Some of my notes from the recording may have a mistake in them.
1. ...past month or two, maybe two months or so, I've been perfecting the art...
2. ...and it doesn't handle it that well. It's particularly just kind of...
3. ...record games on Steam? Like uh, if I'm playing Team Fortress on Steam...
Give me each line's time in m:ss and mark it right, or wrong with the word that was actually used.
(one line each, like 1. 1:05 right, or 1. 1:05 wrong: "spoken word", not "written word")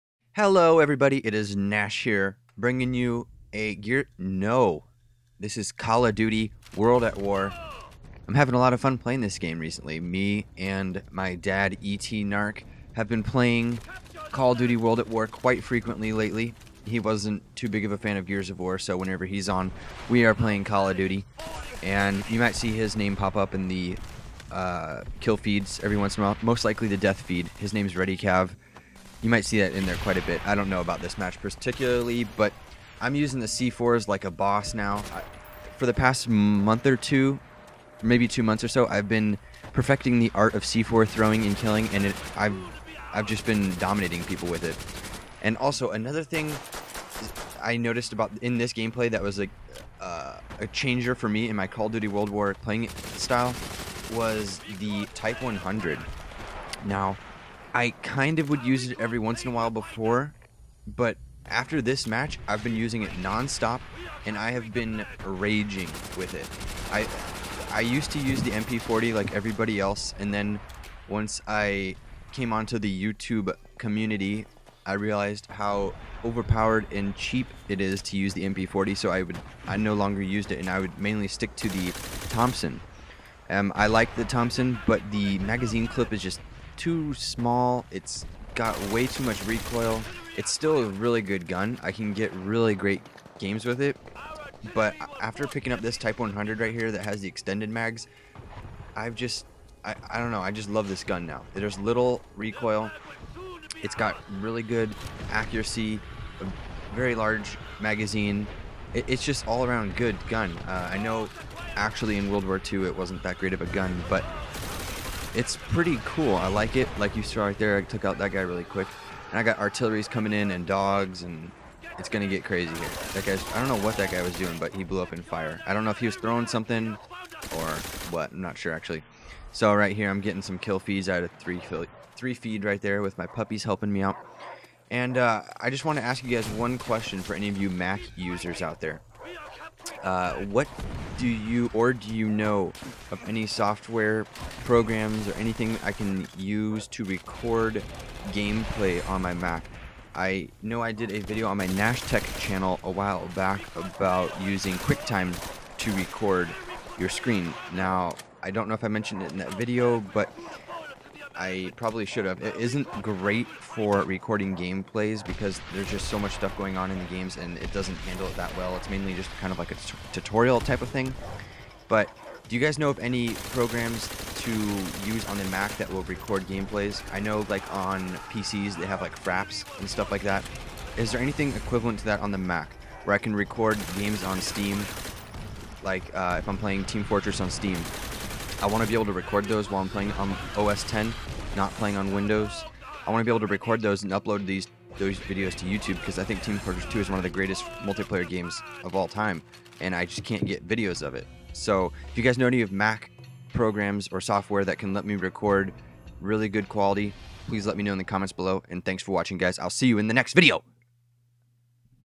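1. 0:35 right
2. 2:47 wrong: "mainly", not "particularly"
3. 3:03 right.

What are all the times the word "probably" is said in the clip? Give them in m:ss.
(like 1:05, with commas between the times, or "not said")
2:41.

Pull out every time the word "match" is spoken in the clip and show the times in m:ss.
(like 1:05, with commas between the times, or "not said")
0:31, 1:02.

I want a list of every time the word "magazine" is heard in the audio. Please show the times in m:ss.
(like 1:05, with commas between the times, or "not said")
1:25, 1:47.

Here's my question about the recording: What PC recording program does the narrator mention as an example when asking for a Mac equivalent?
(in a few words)
Fraps.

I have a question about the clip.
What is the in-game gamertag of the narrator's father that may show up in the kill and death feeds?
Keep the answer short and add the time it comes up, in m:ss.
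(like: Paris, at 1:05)
Ready Cav, at 0:27.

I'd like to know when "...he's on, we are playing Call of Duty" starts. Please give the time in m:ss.
0:19.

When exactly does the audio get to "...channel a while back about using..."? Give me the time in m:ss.
2:32.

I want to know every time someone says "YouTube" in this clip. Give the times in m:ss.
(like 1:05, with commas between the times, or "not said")
1:12, 3:15.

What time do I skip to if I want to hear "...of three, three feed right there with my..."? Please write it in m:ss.
2:11.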